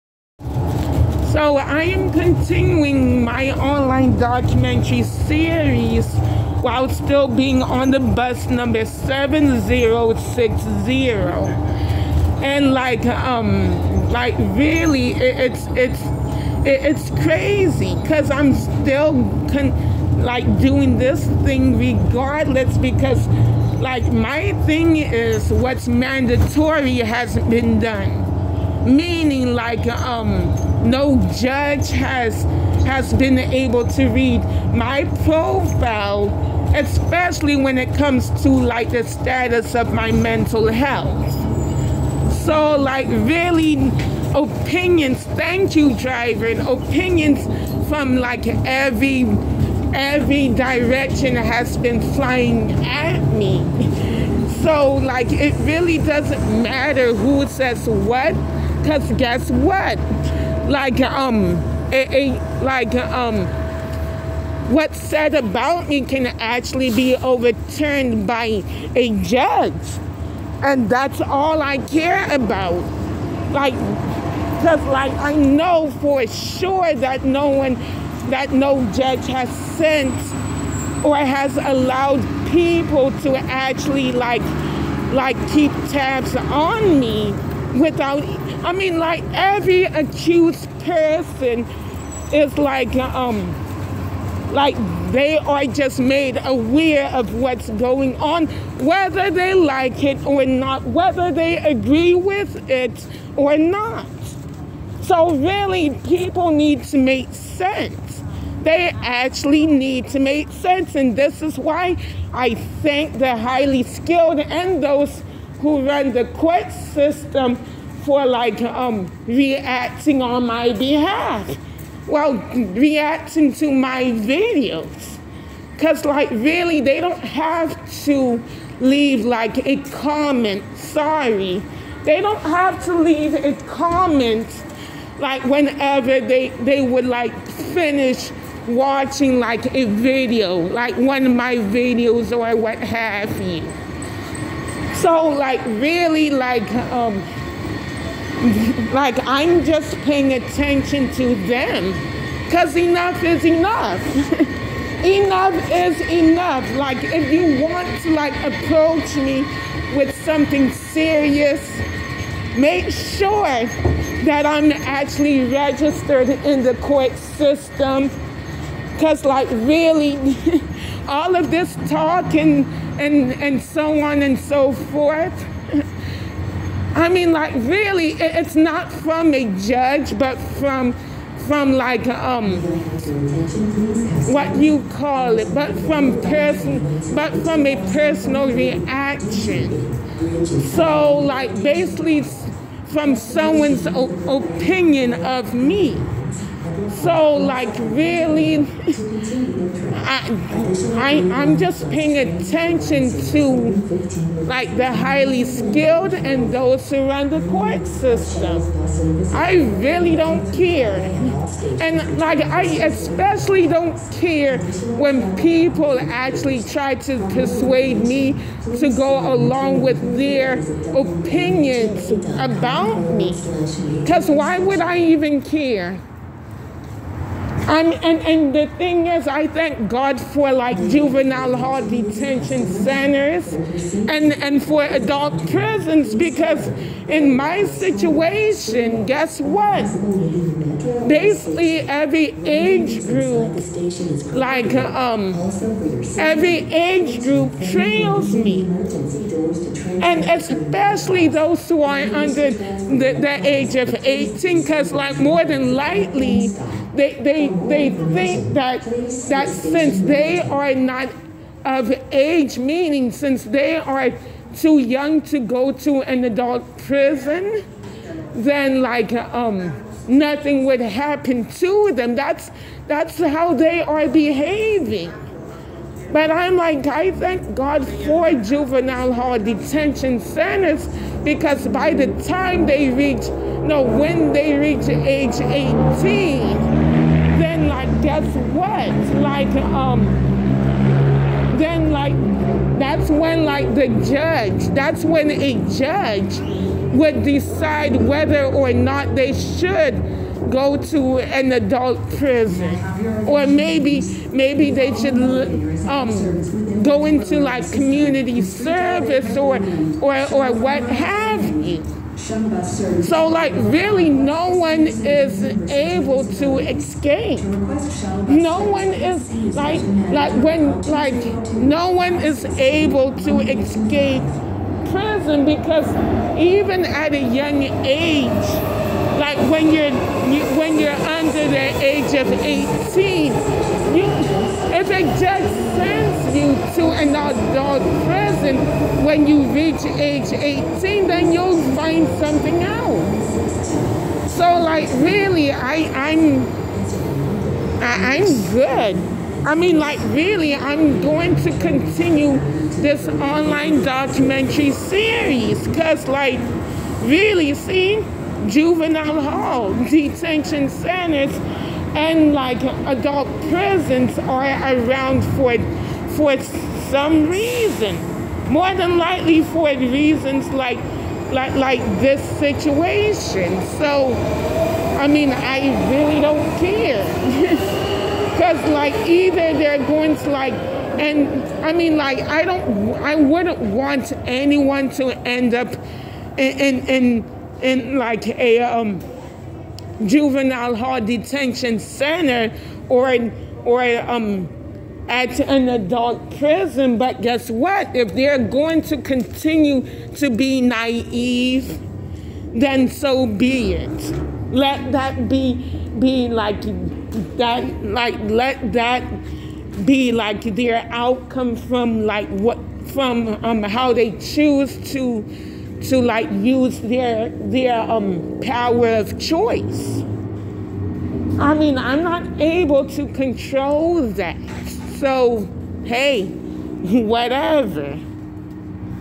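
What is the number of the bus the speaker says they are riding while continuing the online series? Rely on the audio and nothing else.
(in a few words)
7060.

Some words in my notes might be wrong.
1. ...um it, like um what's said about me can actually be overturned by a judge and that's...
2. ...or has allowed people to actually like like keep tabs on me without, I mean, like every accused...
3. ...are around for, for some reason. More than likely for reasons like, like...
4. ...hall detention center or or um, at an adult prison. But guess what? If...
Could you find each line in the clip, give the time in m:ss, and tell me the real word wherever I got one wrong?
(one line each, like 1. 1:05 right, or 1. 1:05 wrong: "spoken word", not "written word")
1. 1:01 right
2. 1:21 right
3. 6:04 right
4. 6:30 right.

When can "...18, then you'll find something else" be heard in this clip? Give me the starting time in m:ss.
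5:40.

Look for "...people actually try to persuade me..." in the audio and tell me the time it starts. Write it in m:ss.
3:35.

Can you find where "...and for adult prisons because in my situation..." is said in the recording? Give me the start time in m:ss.
3:54.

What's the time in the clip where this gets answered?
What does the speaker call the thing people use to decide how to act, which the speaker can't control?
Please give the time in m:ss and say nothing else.
6:58.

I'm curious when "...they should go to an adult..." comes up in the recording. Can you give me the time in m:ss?
4:59.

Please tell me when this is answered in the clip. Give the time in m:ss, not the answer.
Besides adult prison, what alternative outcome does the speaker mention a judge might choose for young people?
5:07.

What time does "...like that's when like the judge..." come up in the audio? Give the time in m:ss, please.
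4:51.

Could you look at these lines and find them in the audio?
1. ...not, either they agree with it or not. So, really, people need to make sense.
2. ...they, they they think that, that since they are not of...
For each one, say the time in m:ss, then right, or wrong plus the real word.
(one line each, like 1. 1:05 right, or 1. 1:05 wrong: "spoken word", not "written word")
1. 1:40 wrong: "whether", not "either"
2. 4:16 right.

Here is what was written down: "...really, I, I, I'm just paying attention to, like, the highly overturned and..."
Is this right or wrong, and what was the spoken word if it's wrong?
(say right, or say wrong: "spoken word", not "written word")
wrong: "skilled", not "overturned".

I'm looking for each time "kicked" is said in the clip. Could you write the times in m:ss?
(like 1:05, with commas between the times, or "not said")
not said.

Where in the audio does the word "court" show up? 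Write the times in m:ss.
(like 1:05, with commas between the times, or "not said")
1:56, 2:46, 3:27.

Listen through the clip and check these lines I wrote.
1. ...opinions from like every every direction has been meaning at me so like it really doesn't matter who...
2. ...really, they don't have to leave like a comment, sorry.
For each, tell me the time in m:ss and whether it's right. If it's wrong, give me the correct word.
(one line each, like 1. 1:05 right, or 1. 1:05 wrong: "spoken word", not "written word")
1. 0:46 wrong: "flying", not "meaning"
2. 2:06 right.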